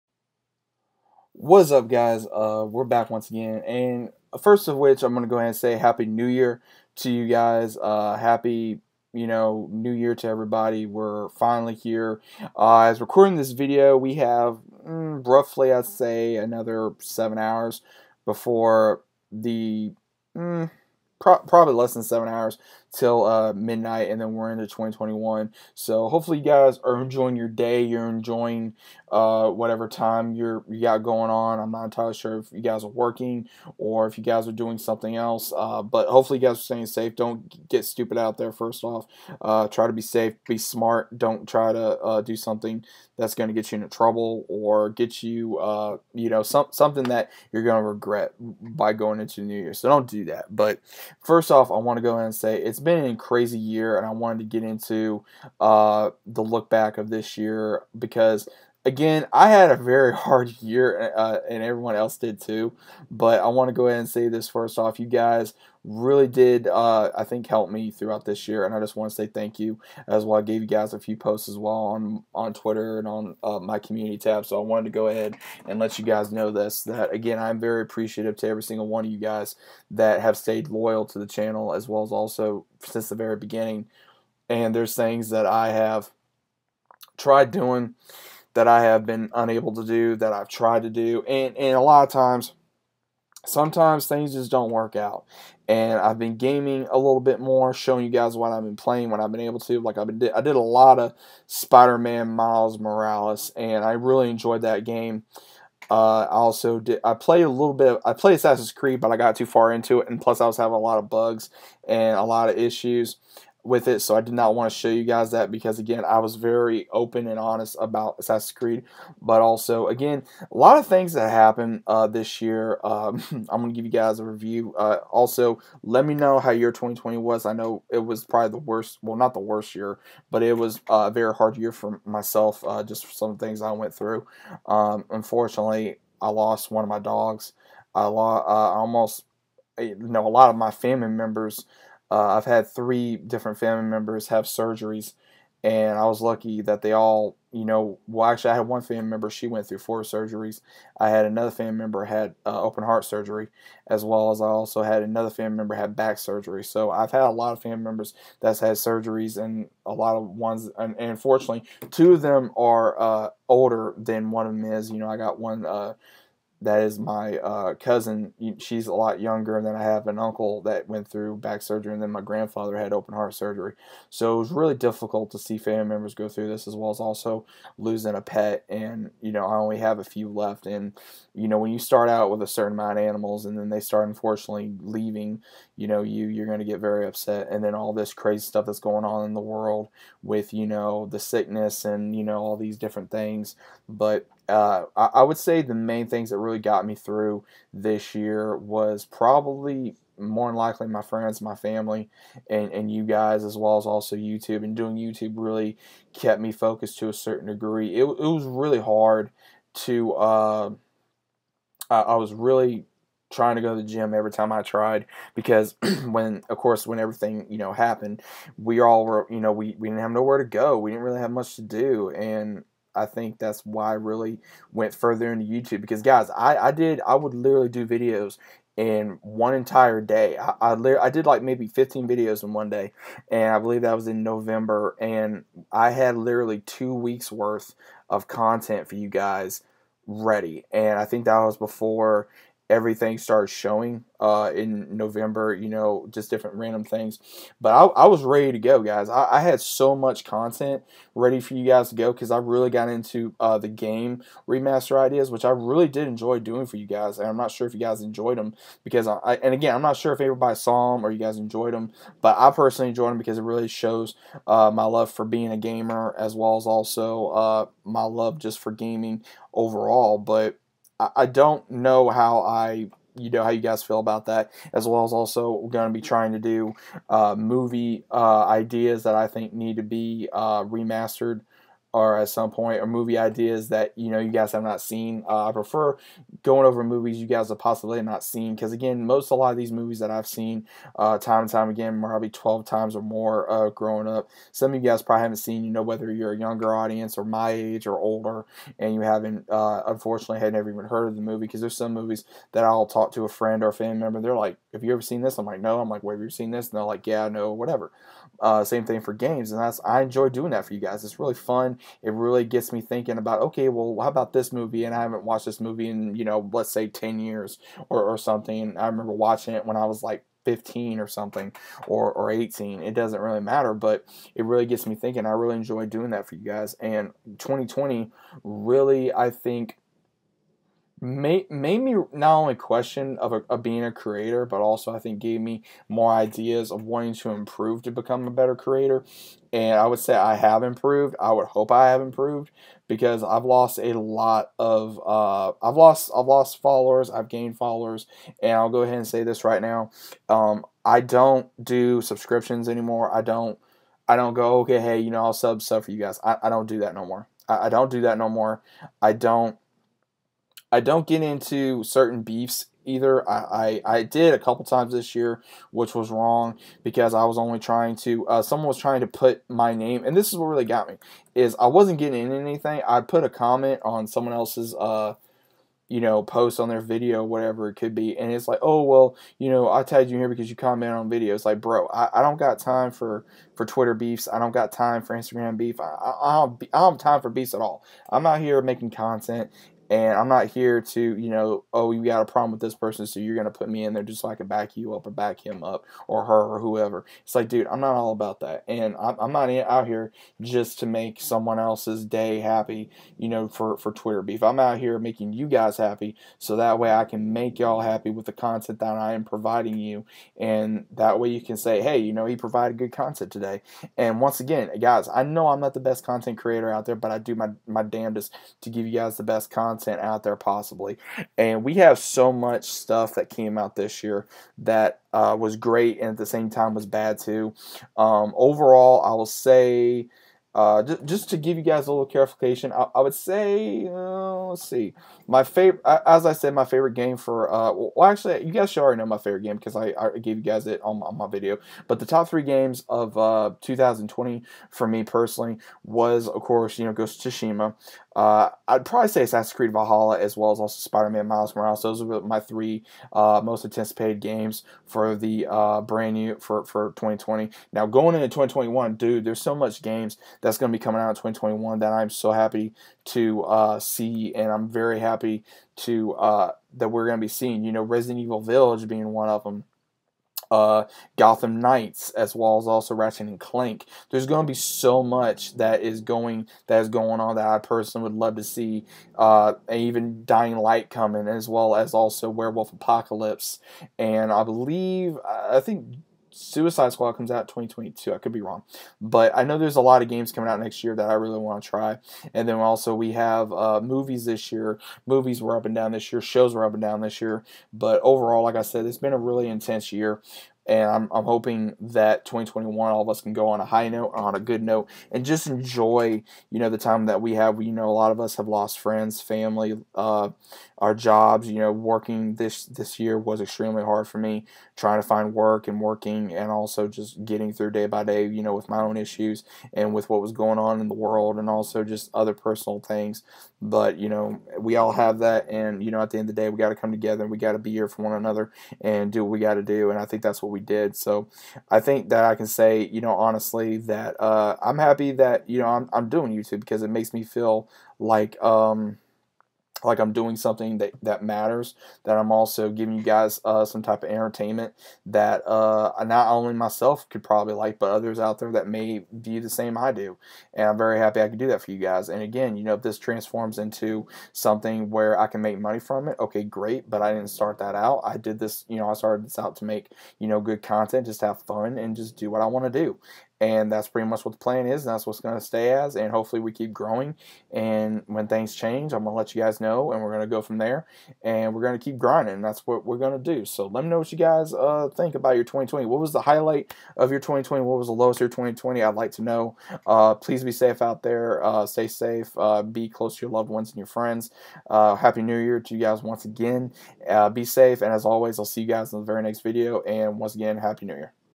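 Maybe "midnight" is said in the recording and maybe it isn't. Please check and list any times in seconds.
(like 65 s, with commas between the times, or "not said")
23 s.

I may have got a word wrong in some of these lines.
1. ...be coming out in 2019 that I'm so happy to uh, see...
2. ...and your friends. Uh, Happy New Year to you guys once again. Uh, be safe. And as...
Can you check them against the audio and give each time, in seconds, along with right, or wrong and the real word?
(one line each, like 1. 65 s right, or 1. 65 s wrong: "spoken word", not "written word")
1. 460 s wrong: "2021", not "2019"
2. 583 s right.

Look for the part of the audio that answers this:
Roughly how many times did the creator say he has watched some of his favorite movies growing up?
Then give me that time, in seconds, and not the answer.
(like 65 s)
292 s.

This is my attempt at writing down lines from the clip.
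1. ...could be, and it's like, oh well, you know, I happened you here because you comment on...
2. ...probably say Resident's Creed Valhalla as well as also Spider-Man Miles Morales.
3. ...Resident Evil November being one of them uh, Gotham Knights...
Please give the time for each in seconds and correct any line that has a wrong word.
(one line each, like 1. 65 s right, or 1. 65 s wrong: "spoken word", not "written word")
1. 377 s wrong: "tagged", not "happened"
2. 448 s wrong: "Assassin", not "Resident"
3. 467 s wrong: "Village", not "November".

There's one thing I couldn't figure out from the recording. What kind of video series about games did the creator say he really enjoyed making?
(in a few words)
game remaster ideas.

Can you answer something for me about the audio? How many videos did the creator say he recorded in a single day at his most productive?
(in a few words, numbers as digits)
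15.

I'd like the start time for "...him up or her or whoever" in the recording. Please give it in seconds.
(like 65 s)
395 s.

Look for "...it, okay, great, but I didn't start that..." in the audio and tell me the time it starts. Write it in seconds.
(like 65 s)
556 s.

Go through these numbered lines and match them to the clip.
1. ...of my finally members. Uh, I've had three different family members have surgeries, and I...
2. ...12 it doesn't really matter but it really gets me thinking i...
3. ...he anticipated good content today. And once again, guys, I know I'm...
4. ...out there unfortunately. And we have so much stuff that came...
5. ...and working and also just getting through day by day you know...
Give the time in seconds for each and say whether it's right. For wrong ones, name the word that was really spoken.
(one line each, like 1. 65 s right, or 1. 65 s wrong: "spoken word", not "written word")
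1. 140 s wrong: "family", not "finally"
2. 322 s wrong: "18", not "12"
3. 412 s wrong: "provided", not "anticipated"
4. 420 s wrong: "possibly", not "unfortunately"
5. 515 s right.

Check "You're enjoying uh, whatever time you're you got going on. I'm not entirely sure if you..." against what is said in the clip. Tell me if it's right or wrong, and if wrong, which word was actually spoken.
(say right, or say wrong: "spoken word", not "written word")
right.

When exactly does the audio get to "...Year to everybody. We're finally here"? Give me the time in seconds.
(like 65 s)
9 s.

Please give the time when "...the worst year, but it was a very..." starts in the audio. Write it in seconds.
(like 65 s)
129 s.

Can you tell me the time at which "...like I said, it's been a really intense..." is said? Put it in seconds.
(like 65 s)
498 s.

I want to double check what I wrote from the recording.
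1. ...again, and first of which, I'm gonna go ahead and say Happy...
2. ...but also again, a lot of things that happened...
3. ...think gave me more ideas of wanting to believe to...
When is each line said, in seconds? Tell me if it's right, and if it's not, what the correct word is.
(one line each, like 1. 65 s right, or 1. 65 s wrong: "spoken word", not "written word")
1. 3 s right
2. 119 s right
3. 334 s wrong: "improve", not "believe".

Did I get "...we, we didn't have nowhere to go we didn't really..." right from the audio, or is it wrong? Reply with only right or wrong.
right.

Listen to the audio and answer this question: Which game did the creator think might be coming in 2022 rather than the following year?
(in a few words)
Suicide Squad.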